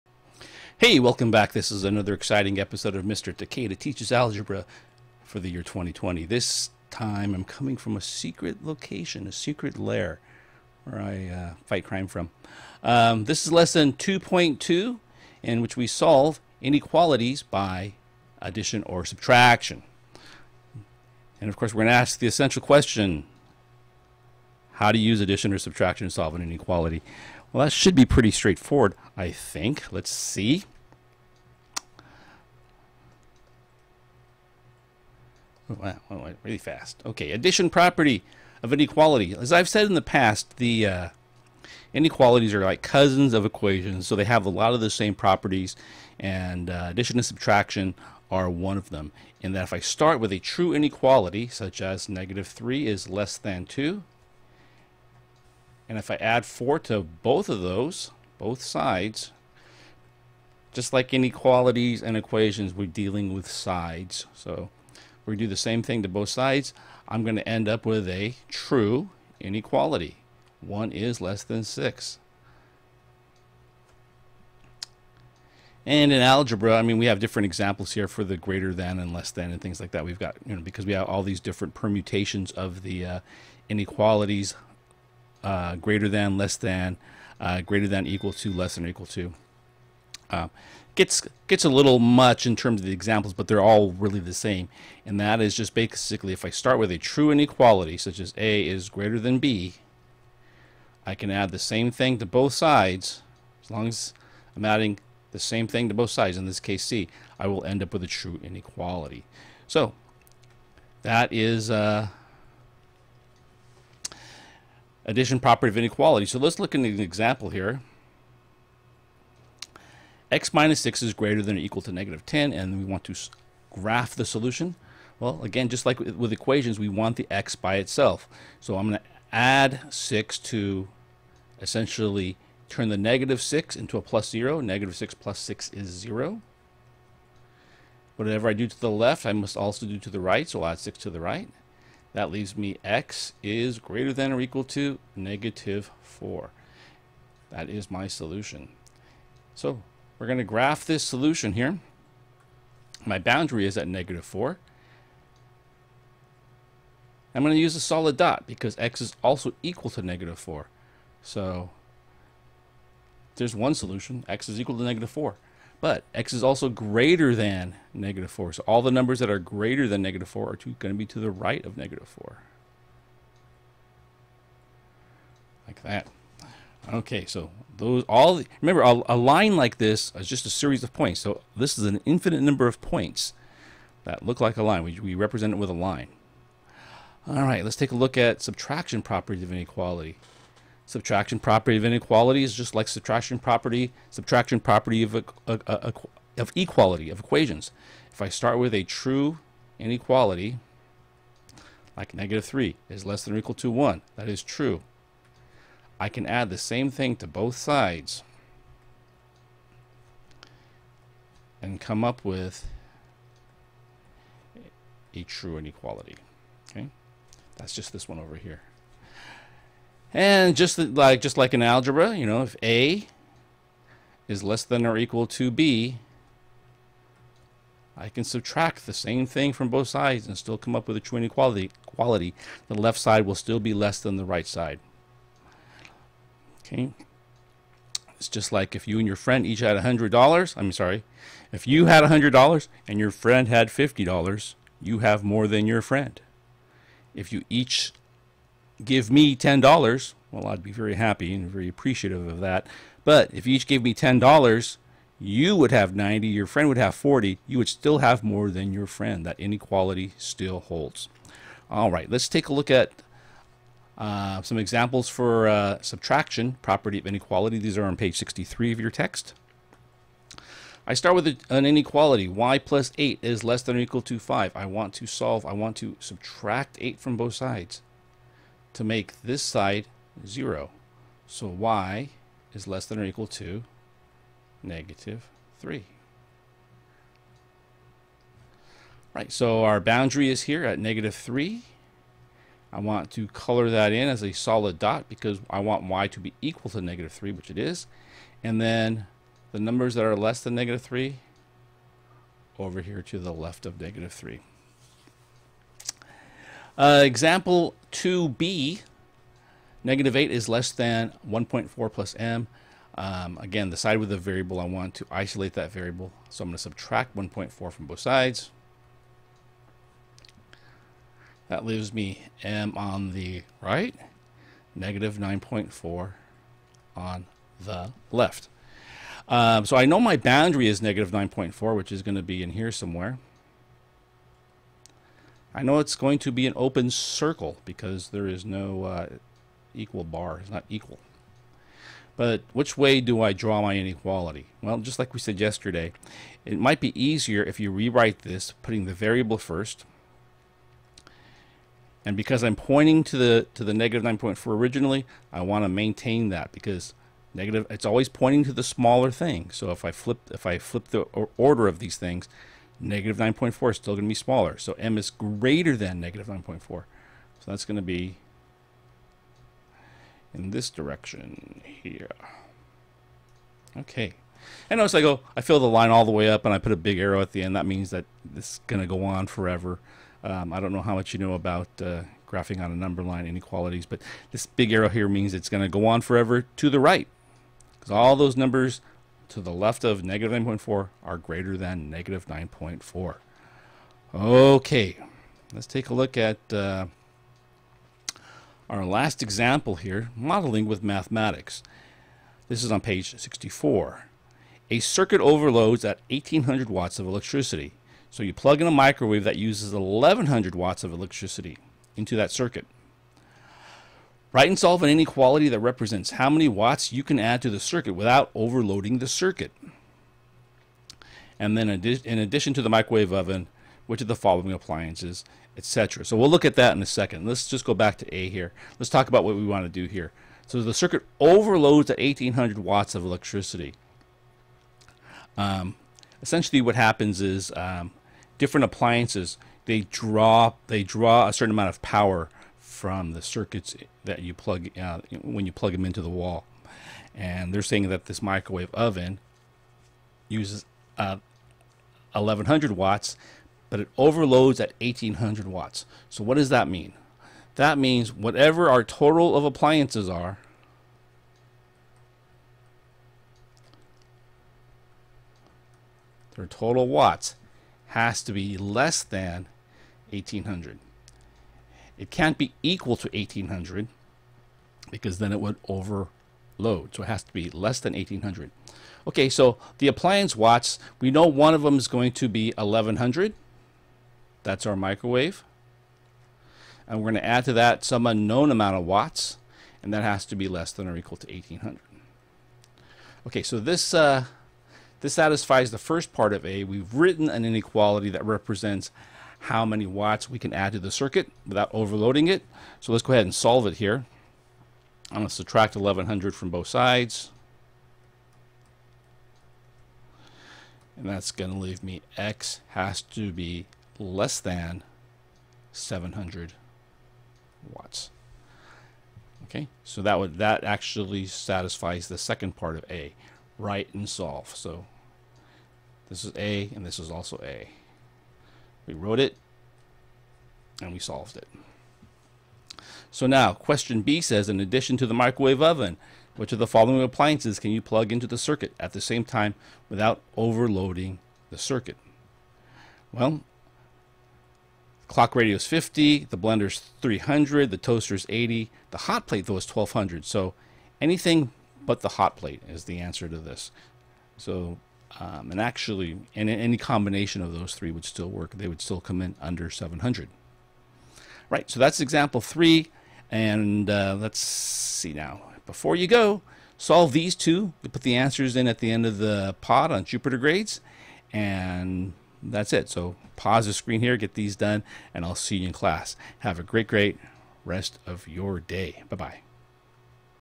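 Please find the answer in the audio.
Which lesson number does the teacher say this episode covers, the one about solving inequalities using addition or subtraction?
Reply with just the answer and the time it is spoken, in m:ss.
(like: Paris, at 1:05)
2.2, at 0:13.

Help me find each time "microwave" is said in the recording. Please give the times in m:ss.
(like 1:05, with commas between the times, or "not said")
6:48, 7:02, 7:28, 8:04, 8:55.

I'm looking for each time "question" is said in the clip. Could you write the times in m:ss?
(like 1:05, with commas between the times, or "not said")
0:22, 8:53.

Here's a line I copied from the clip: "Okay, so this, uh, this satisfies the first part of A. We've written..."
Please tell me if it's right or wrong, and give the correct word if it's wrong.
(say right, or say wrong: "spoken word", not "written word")
right.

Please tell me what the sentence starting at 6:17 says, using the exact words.
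That means that this is going to go on forever.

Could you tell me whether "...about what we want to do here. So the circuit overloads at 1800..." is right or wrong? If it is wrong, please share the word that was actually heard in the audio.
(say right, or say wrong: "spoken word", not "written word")
right.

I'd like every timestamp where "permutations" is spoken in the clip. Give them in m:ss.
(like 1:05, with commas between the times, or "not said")
1:21.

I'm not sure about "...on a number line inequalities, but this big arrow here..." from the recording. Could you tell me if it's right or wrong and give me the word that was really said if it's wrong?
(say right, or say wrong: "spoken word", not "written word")
right.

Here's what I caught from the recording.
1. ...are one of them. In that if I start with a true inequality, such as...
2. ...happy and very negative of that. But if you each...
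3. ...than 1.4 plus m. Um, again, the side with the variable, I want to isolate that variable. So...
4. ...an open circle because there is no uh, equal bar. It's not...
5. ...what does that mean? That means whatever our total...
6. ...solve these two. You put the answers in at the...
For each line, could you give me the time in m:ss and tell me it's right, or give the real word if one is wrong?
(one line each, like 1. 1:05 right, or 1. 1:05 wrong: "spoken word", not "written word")
1. 0:48 right
2. 4:10 wrong: "appreciative", not "negative"
3. 5:10 right
4. 5:36 right
5. 7:36 right
6. 9:26 right.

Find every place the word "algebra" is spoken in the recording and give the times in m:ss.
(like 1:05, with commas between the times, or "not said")
0:04, 1:16, 3:41.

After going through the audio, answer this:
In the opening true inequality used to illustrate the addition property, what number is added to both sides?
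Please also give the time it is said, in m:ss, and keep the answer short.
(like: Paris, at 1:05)
4, at 0:56.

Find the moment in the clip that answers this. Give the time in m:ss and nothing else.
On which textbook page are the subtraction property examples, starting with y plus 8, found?
4:27.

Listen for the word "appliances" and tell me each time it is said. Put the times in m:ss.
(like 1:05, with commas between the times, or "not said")
7:04, 7:18, 7:39, 7:59, 8:57.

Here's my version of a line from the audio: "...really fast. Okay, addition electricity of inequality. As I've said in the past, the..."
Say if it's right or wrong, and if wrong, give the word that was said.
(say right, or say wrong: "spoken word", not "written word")
wrong: "property", not "electricity".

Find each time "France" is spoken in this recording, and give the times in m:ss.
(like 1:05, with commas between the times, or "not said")
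not said.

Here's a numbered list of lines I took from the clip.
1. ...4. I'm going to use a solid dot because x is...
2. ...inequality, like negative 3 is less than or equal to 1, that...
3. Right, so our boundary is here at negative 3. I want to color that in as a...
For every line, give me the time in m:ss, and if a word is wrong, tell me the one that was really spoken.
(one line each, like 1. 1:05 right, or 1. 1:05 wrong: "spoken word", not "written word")
1. 2:34 right
2. 3:19 right
3. 4:49 right.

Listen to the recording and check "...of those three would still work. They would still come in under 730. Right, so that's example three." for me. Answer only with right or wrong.
wrong.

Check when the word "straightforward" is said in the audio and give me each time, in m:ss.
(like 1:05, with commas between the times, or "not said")
0:28.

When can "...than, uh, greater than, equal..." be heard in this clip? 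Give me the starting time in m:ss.
1:26.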